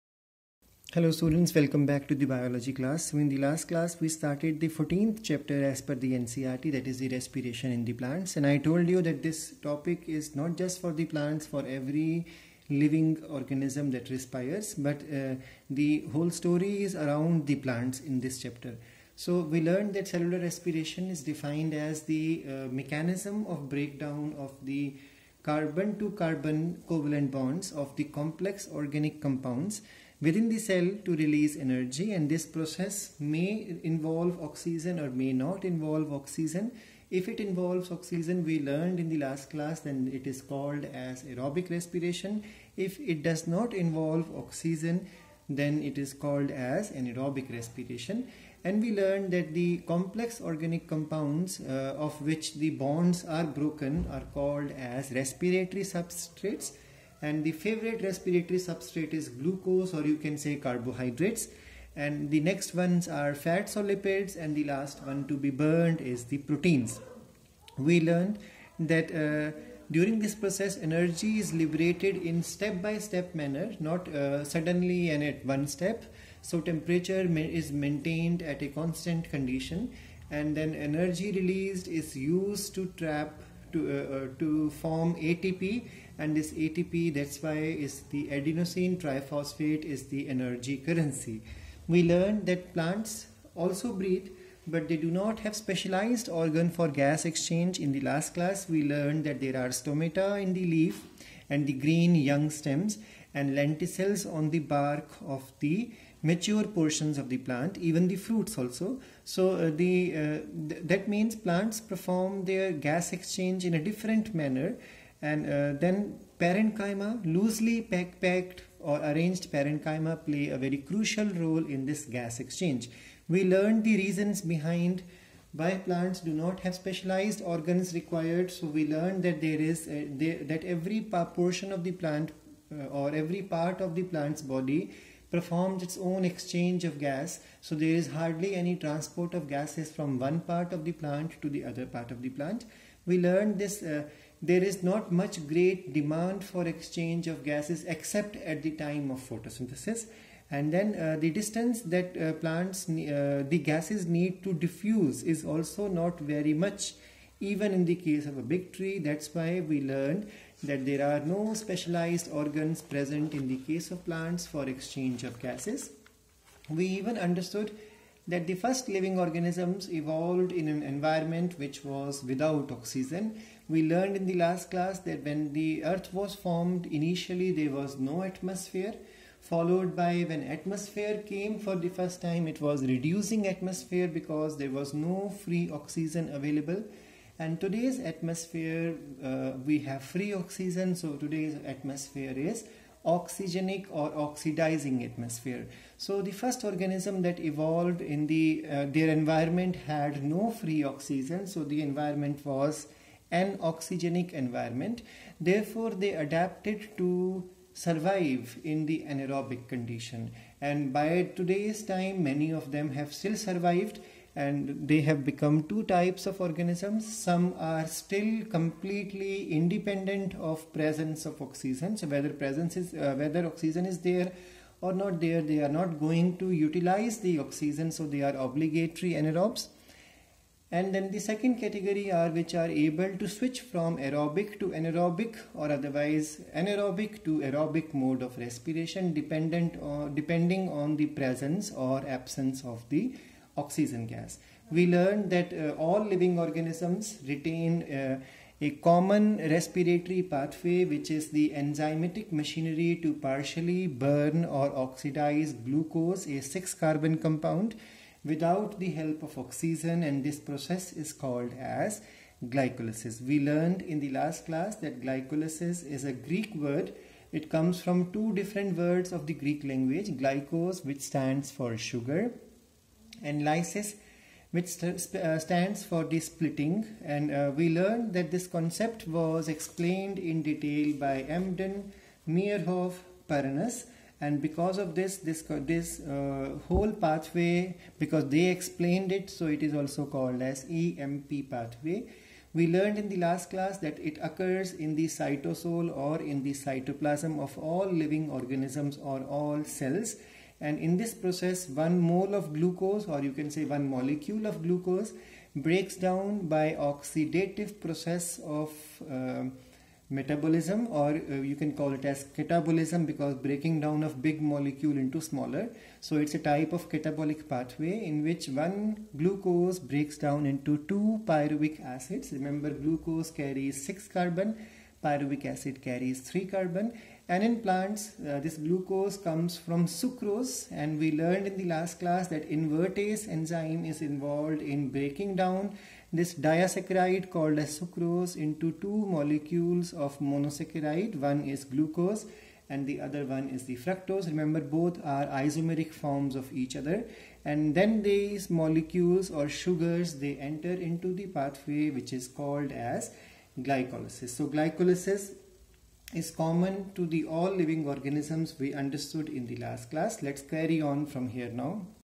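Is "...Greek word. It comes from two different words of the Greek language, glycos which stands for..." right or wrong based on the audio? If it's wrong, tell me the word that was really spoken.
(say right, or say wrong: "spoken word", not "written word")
right.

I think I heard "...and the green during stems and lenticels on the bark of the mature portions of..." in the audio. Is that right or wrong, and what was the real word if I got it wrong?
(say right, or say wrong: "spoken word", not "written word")
wrong: "young", not "during".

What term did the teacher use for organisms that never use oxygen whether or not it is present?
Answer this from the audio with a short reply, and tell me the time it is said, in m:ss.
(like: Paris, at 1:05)
obligatory anaerobes, at 3:48.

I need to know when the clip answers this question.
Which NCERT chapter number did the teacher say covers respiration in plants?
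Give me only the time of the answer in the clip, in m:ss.
0:04.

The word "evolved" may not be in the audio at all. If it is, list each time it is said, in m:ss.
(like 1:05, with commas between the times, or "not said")
2:49, 3:17.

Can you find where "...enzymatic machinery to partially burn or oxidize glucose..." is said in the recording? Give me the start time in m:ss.
4:11.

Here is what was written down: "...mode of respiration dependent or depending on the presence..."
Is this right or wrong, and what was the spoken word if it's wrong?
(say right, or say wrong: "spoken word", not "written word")
right.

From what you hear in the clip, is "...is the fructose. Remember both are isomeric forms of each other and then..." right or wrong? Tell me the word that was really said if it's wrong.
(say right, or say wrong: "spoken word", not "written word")
right.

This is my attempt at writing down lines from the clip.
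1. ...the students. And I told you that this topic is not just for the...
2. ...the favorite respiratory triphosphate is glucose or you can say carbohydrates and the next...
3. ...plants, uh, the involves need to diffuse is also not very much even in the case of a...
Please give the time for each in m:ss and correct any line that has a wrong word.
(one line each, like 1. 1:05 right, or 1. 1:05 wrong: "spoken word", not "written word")
1. 0:07 wrong: "plants", not "students"
2. 0:57 wrong: "substrate", not "triphosphate"
3. 2:32 wrong: "gases", not "involves".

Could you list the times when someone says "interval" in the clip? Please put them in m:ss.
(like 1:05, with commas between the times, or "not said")
not said.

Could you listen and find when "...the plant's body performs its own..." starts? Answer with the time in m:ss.
2:13.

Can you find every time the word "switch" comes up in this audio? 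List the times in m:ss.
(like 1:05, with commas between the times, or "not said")
3:53.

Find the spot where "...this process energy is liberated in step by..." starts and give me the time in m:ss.
1:10.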